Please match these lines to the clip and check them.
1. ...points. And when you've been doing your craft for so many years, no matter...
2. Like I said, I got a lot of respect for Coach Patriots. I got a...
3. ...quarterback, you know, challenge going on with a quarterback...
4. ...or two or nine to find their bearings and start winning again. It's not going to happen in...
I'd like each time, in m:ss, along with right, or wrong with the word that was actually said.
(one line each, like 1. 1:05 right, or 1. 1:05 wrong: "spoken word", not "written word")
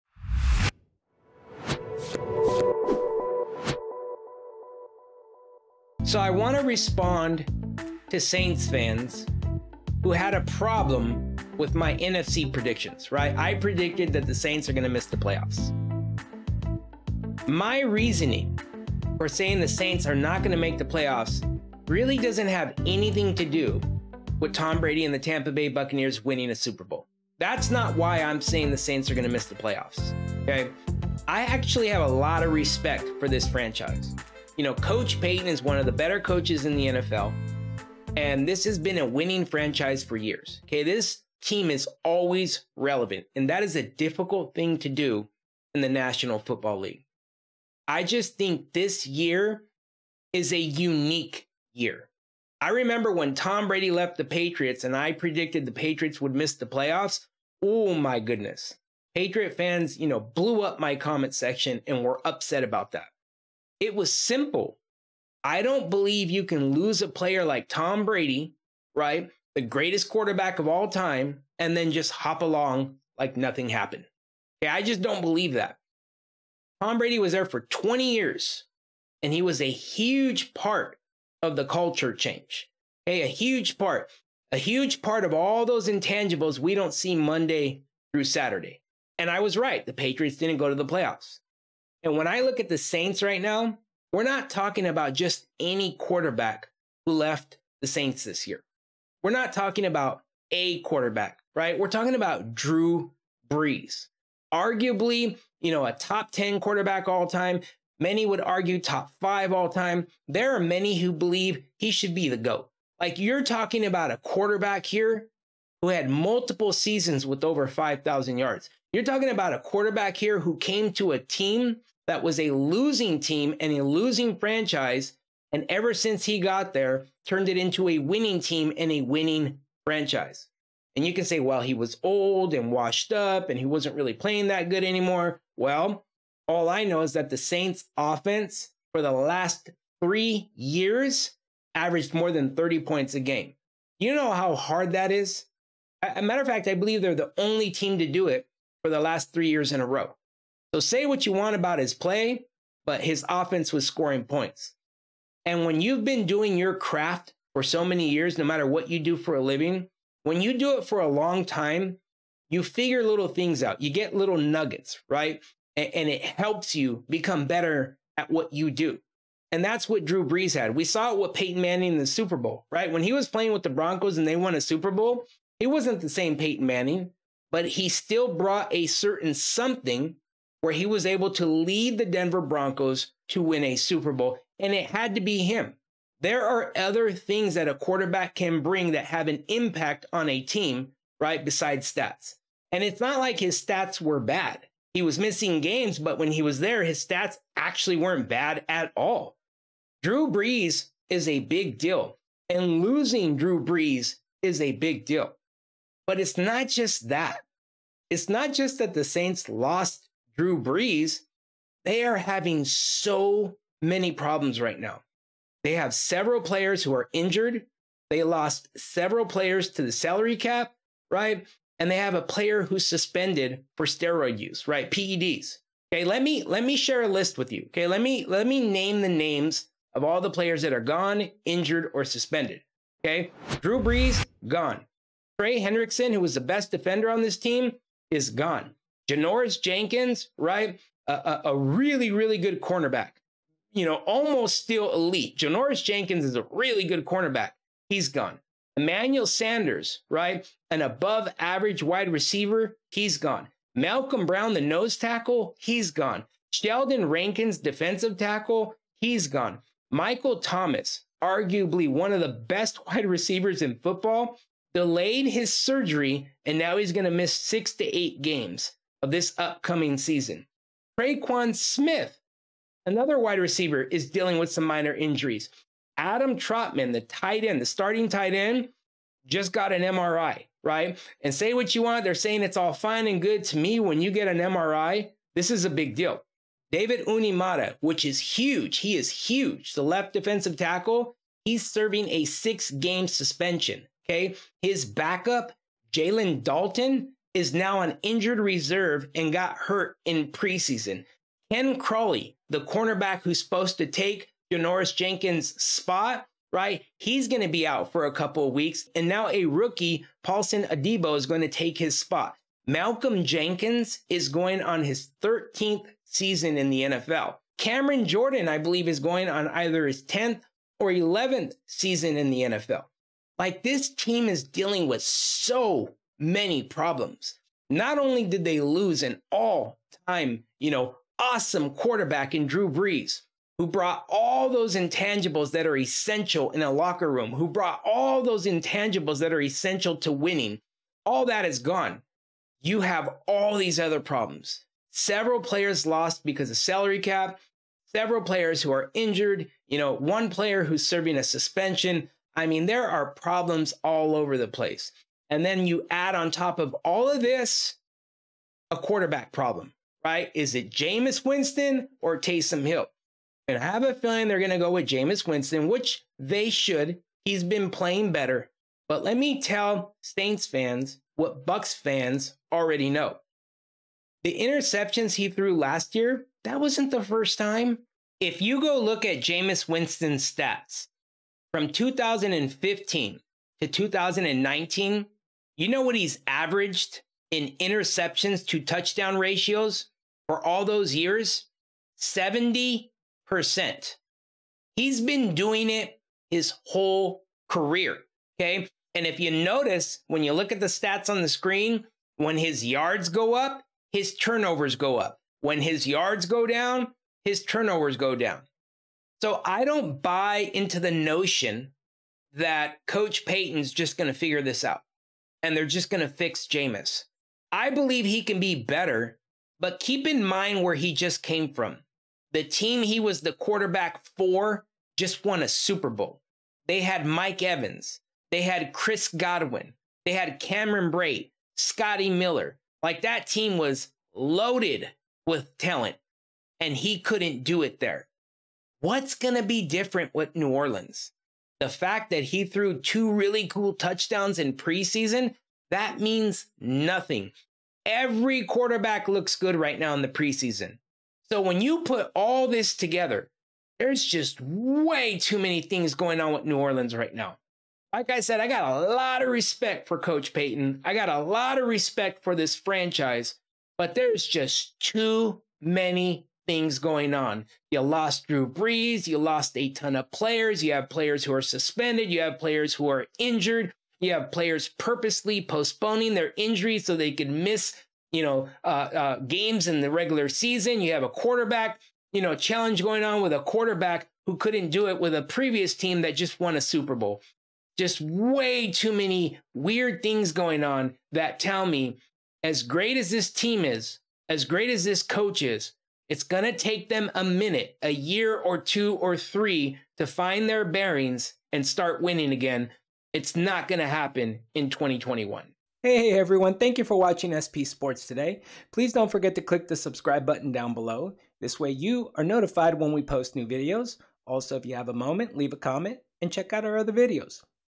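1. 2:34 right
2. 7:37 wrong: "Payton", not "Patriots"
3. 8:01 right
4. 8:18 wrong: "three", not "nine".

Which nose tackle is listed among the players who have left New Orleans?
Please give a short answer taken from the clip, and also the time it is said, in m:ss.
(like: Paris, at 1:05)
Malcolm Brown, at 4:13.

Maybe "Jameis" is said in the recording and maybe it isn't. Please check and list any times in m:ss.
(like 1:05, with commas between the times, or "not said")
6:00, 6:04, 6:19, 6:56.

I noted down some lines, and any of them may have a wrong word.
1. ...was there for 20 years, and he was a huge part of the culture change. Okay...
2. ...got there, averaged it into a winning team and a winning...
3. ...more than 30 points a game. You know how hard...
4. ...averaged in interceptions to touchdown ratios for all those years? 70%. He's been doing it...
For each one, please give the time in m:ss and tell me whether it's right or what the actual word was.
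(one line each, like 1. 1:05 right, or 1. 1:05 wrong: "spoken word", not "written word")
1. 1:17 right
2. 2:06 wrong: "turned", not "averaged"
3. 2:22 right
4. 6:26 right.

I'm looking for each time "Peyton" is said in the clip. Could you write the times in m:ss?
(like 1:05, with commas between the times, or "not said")
2:51, 2:56.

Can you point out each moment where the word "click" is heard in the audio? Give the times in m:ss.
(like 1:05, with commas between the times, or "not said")
8:29.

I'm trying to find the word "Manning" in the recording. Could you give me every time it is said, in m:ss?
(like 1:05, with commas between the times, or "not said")
2:51, 2:56.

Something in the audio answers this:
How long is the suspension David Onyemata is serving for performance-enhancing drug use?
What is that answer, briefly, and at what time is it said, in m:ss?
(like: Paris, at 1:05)
6 games, at 4:52.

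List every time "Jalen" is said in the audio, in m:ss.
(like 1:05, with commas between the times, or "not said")
4:55.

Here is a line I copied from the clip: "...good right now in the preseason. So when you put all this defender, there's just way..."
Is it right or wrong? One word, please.
wrong.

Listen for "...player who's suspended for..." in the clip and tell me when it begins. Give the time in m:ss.
3:42.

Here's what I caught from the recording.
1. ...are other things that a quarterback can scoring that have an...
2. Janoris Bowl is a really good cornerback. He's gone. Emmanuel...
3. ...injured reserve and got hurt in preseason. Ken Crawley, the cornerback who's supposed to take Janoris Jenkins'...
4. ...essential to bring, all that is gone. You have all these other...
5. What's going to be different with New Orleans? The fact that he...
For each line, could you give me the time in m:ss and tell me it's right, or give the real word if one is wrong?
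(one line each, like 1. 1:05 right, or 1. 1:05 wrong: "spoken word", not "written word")
1. 3:06 wrong: "bring", not "scoring"
2. 4:05 wrong: "Jenkins", not "Bowl"
3. 4:58 right
4. 5:39 wrong: "winning", not "bring"
5. 7:18 right.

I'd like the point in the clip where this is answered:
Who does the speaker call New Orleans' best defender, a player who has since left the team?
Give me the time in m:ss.
3:55.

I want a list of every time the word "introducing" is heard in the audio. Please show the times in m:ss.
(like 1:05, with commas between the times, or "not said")
not said.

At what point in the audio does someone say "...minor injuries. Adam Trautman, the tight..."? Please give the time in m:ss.
4:34.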